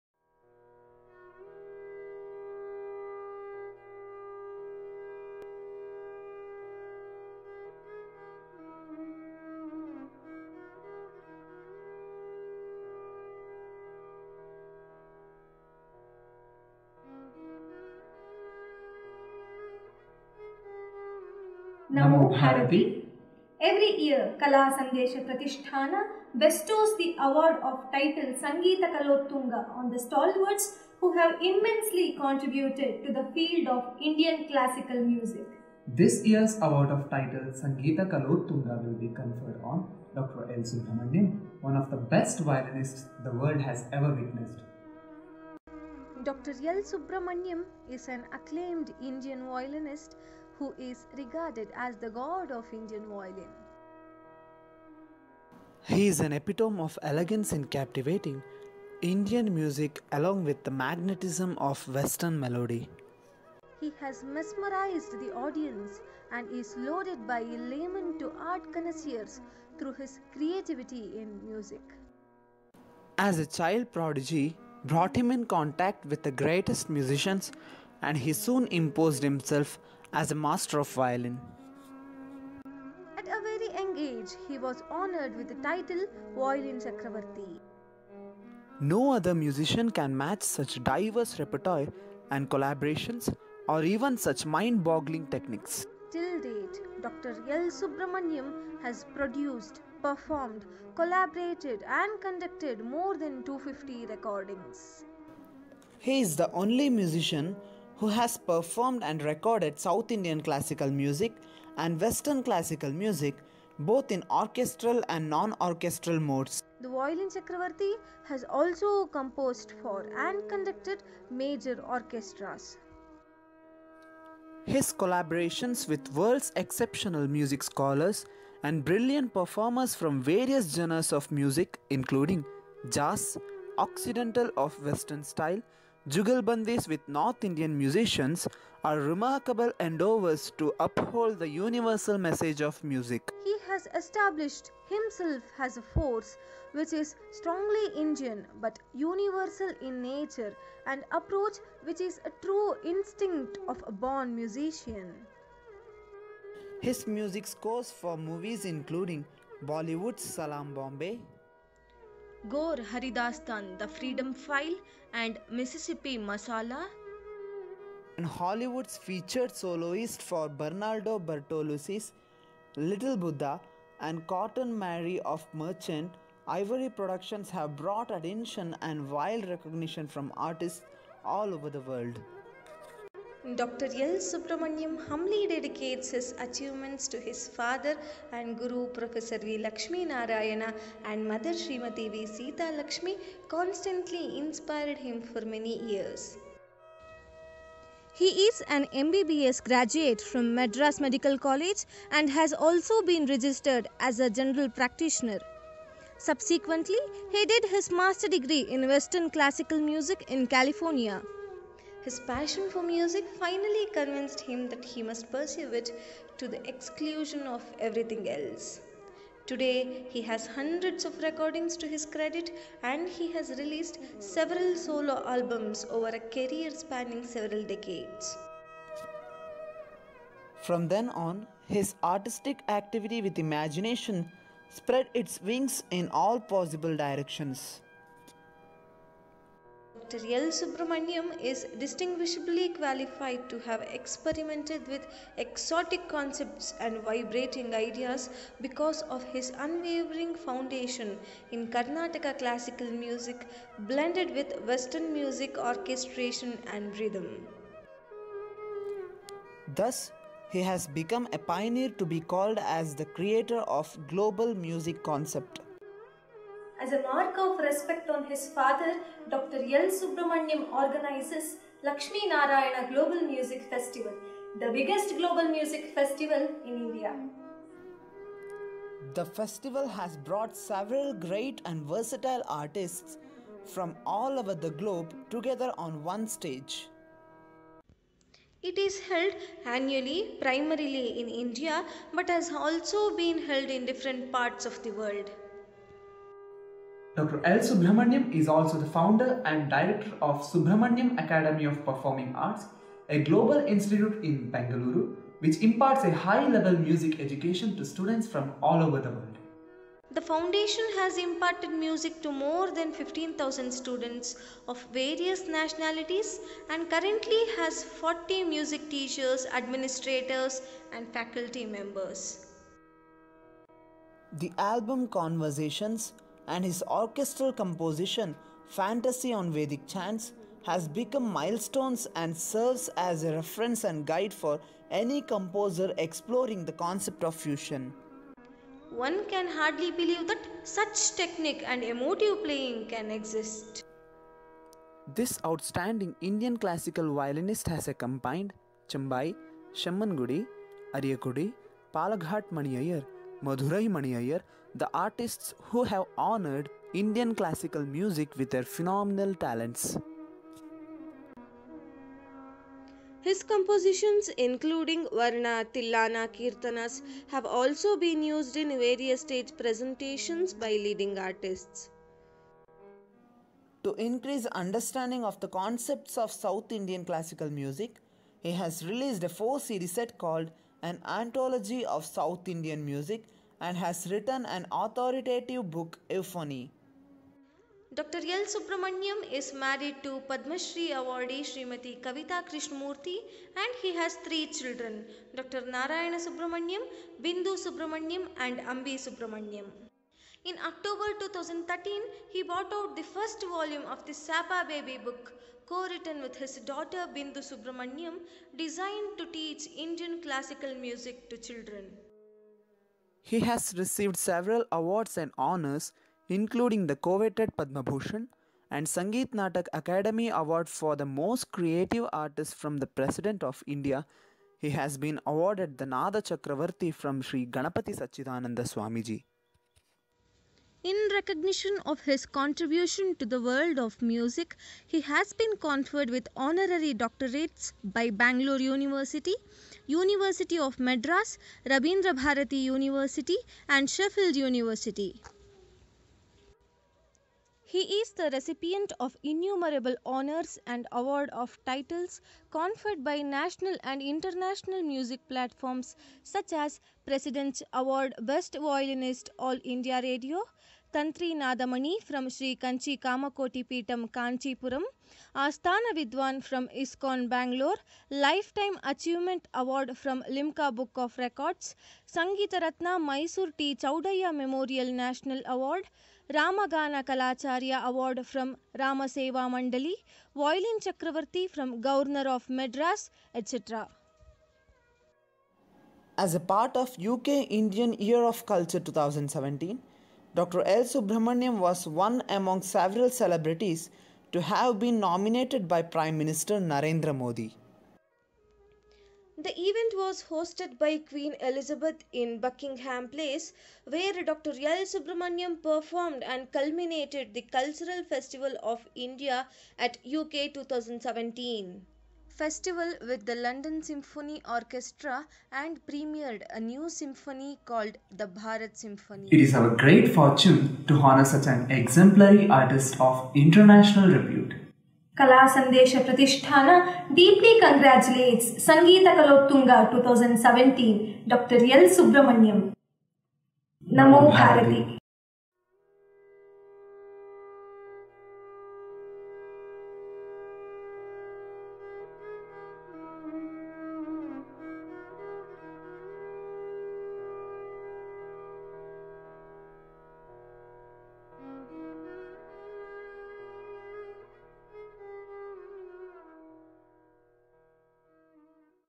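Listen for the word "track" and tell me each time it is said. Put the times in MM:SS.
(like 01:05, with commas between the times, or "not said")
not said.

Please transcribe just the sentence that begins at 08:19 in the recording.
The event was hosted by Queen Elizabeth in Buckingham Palace, where Dr.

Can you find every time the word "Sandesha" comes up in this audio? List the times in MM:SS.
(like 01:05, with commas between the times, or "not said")
00:24, 08:45.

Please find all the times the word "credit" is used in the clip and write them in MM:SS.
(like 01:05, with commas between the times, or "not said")
03:42.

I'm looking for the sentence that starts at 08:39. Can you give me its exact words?
It is our great fortune to honor such an exemplary artist of international repute.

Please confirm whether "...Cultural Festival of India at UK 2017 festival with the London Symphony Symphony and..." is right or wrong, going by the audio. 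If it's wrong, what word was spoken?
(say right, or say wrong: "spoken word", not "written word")
wrong: "Orchestra", not "Symphony".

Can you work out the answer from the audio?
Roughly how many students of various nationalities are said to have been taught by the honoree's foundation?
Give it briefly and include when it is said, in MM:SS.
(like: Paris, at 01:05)
15,000, at 05:12.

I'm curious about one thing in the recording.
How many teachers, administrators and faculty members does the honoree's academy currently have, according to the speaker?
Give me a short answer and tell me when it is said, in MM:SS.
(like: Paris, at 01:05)
40, at 05:17.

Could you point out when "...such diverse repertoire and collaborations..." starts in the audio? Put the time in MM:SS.
01:30.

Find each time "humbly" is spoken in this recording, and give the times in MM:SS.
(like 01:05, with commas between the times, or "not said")
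03:05.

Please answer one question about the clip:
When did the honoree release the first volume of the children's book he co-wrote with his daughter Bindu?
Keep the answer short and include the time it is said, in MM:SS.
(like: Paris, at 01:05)
October 2013, at 06:40.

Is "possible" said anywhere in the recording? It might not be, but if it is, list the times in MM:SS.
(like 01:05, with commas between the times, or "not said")
03:56.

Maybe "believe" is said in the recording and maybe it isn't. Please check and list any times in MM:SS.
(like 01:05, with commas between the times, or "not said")
05:39.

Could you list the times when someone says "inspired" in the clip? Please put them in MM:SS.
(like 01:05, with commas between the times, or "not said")
03:14.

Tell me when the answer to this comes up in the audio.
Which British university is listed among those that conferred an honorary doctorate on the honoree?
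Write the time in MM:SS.
07:23.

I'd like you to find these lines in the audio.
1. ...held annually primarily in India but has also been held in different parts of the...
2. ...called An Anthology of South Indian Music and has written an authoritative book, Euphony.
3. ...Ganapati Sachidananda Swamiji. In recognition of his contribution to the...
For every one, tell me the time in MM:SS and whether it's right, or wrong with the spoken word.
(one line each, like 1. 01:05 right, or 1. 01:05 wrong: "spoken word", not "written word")
1. 04:49 right
2. 06:20 right
3. 07:07 right.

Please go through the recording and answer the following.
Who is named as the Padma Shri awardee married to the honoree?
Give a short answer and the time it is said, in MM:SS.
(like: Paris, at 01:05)
Kavita Krishnamurti, at 06:32.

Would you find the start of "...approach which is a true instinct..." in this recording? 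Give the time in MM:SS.
02:31.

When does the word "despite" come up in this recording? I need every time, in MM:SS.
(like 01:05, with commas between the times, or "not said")
not said.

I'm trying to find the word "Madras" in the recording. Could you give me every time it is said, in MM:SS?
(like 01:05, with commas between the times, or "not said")
03:20, 07:20.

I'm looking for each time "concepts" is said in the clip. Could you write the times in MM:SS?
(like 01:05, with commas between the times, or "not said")
04:06, 04:25, 05:36, 06:15.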